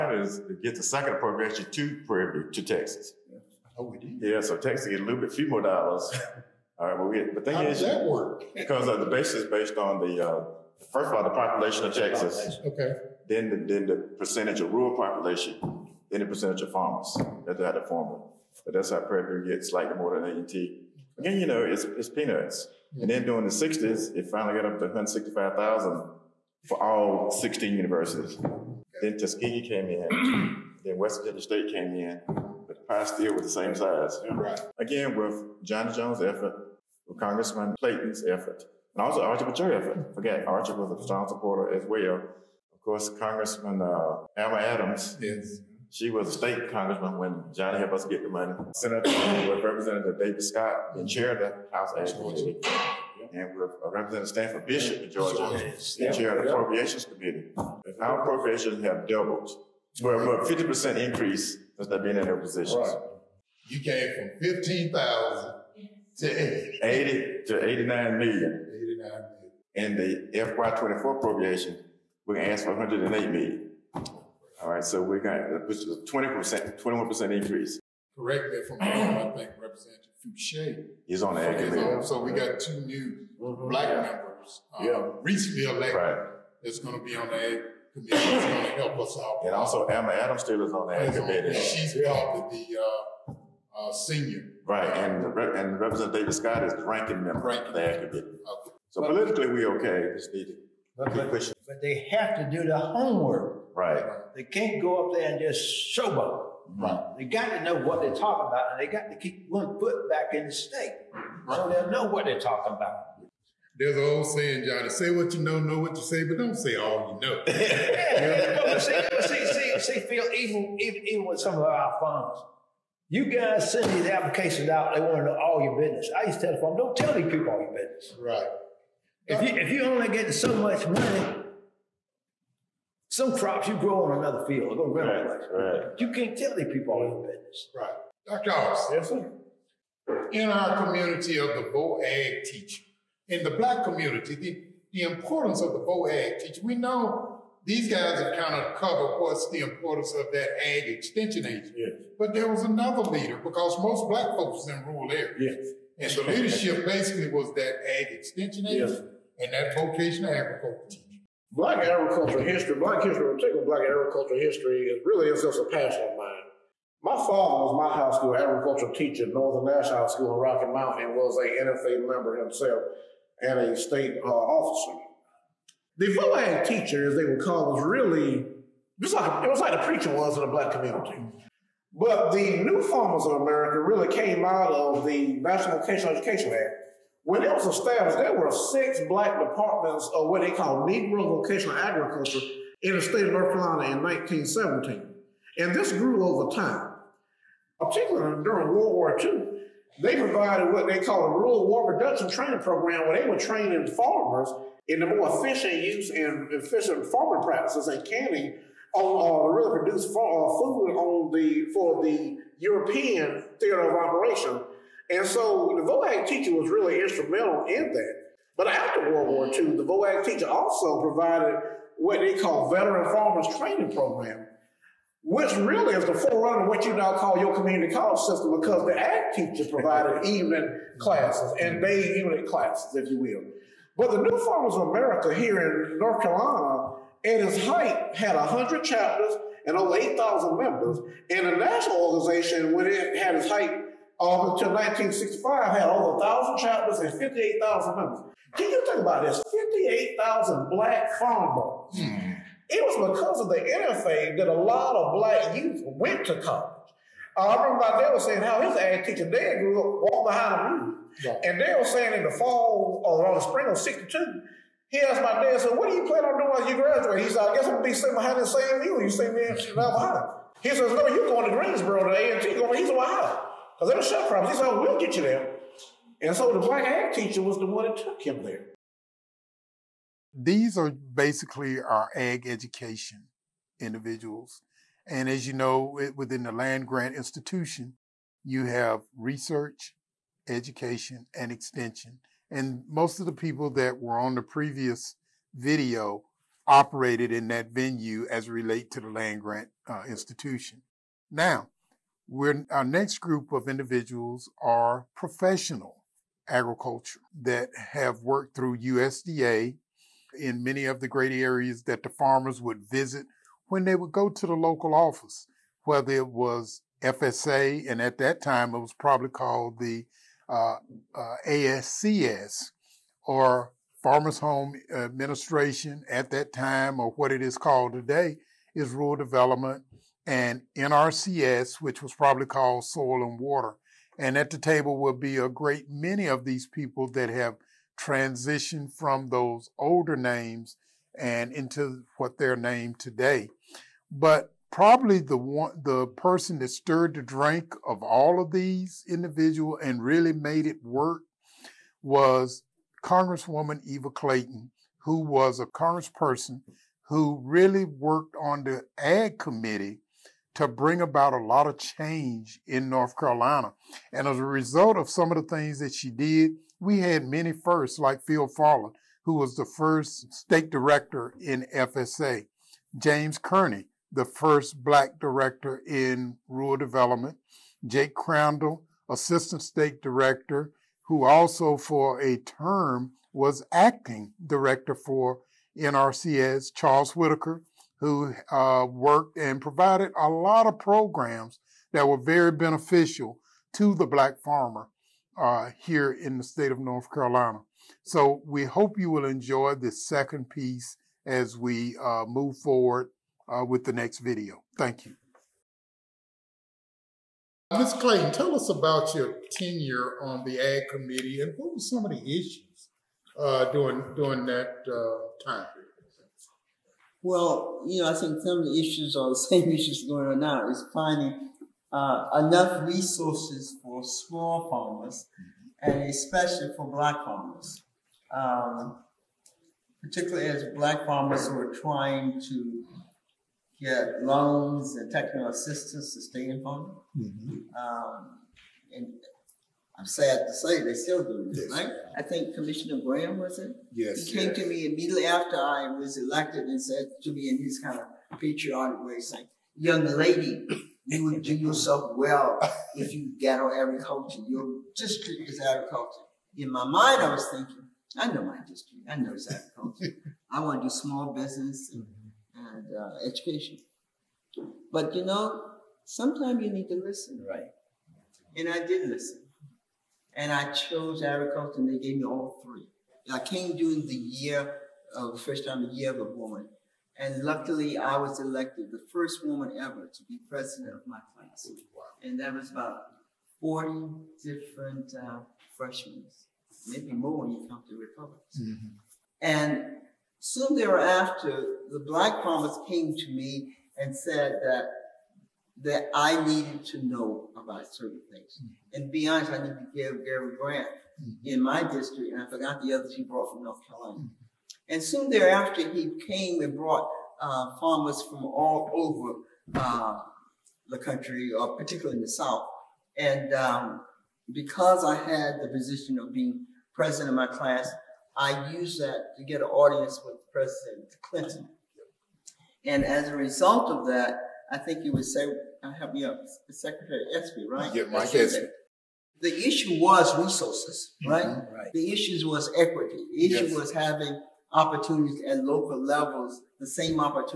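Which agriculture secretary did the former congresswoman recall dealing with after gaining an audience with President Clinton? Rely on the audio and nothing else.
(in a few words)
Mike Espy.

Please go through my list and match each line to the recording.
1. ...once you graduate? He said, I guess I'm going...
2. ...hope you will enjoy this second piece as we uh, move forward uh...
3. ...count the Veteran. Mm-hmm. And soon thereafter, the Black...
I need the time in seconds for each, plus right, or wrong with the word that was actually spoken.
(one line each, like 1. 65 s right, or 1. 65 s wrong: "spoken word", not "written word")
1. 266 s right
2. 398 s right
3. 487 s wrong: "Republicans", not "Veteran".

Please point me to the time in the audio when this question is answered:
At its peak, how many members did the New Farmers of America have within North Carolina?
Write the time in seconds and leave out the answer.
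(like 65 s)
239 s.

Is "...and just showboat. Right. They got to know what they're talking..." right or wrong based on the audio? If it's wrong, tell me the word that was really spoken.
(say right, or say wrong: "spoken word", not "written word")
right.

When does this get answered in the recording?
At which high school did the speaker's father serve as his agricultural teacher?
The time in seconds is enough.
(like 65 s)
169 s.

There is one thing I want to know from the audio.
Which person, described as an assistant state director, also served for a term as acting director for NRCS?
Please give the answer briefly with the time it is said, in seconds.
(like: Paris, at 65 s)
Jake Crandall, at 377 s.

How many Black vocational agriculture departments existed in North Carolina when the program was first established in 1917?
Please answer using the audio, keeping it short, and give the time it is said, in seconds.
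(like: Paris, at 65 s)
6, at 188 s.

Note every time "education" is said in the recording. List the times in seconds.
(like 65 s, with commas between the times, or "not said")
186 s, 282 s, 290 s, 463 s.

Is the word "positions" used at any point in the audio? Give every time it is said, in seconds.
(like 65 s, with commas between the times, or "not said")
62 s, 515 s.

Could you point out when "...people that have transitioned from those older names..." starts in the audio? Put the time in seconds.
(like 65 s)
336 s.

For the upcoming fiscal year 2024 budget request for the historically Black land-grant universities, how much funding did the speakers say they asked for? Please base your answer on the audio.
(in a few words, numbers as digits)
108 million.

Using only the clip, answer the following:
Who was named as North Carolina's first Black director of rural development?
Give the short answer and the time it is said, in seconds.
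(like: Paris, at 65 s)
James Kearney, at 372 s.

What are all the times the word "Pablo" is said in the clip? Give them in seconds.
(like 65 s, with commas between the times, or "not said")
not said.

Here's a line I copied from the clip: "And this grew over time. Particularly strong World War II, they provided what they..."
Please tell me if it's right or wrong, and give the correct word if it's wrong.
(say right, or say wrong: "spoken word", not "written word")
wrong: "during", not "strong".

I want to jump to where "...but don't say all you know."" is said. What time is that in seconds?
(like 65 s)
116 s.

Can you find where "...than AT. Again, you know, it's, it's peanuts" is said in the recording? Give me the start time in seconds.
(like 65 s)
20 s.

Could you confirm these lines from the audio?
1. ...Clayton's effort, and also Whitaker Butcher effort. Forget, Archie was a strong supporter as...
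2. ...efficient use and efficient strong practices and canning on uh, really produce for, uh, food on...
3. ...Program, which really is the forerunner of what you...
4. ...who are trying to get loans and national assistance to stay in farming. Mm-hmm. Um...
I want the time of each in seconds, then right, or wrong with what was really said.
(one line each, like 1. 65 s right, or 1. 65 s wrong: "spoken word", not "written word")
1. 37 s wrong: "Archie", not "Whitaker"
2. 205 s wrong: "farming", not "strong"
3. 223 s right
4. 431 s wrong: "technical", not "national".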